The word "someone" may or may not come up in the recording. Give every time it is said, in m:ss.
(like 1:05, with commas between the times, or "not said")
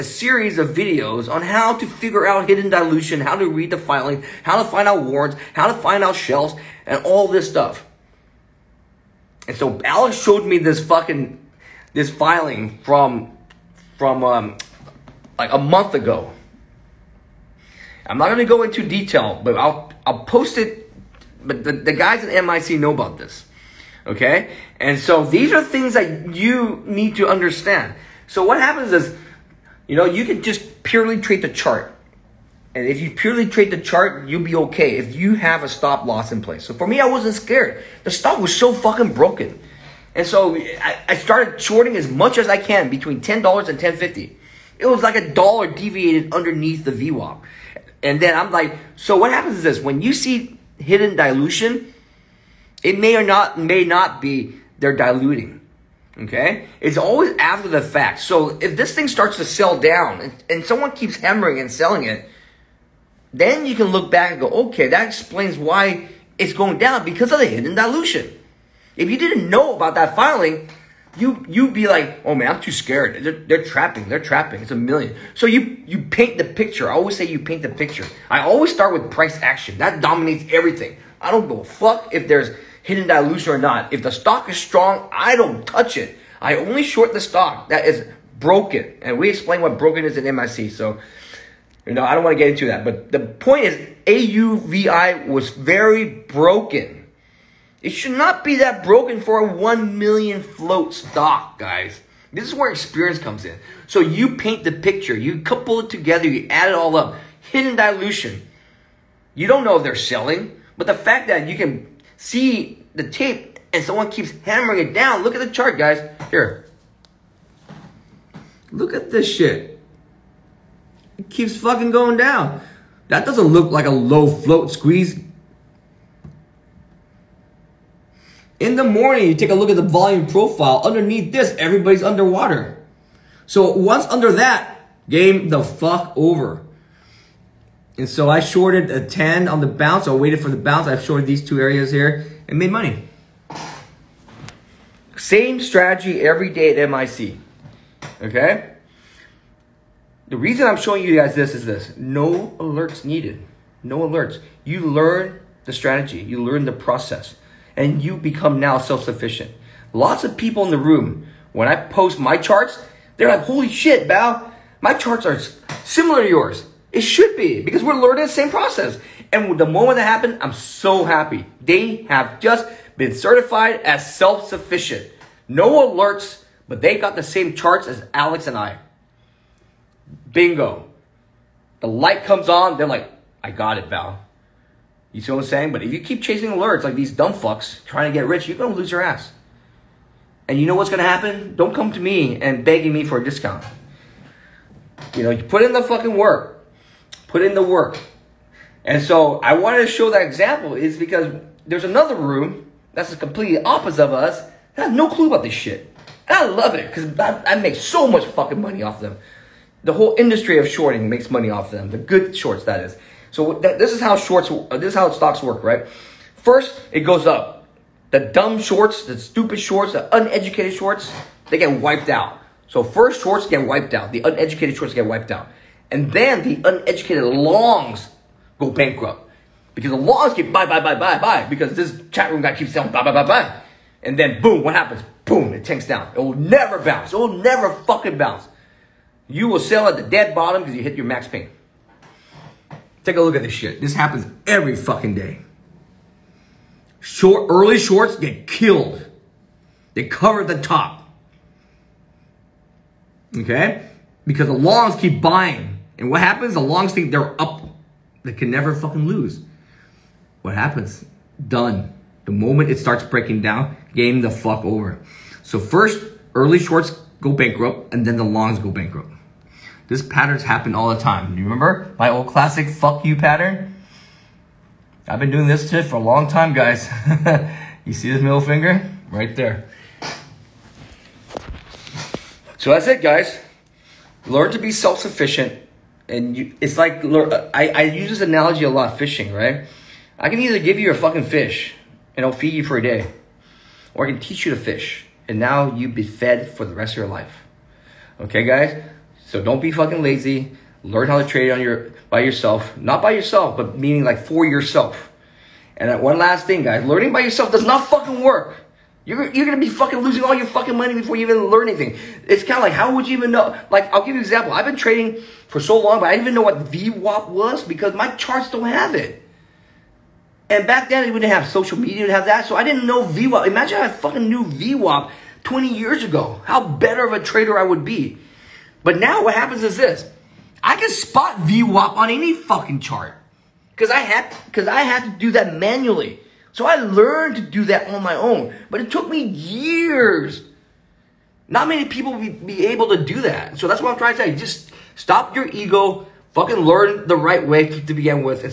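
1:00, 1:53.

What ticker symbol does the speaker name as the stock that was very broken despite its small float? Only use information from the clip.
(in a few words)
AUVI.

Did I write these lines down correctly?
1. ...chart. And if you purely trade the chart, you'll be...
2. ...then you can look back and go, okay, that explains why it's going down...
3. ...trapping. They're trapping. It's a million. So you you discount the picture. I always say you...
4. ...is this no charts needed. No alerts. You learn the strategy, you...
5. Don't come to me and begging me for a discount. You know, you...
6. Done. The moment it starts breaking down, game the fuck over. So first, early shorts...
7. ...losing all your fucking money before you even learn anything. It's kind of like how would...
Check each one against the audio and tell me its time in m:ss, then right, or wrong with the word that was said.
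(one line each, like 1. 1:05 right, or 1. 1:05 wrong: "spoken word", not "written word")
1. 0:31 right
2. 1:03 right
3. 1:13 wrong: "paint", not "discount"
4. 2:31 wrong: "alerts", not "charts"
5. 3:11 right
6. 4:21 right
7. 5:09 right.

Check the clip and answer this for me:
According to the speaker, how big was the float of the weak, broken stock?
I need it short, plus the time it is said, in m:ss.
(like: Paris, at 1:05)
1 million, at 1:39.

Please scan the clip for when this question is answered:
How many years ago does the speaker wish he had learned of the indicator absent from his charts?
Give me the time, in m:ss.
5:25.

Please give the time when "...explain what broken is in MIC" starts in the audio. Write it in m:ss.
1:29.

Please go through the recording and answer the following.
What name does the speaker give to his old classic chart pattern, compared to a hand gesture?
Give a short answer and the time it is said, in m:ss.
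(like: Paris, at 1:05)
fuck you pattern, at 4:32.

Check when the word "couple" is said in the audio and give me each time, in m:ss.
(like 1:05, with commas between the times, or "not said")
1:45.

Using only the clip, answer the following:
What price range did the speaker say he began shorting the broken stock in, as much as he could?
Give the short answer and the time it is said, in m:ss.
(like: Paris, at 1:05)
$10 to $10.50, at 0:43.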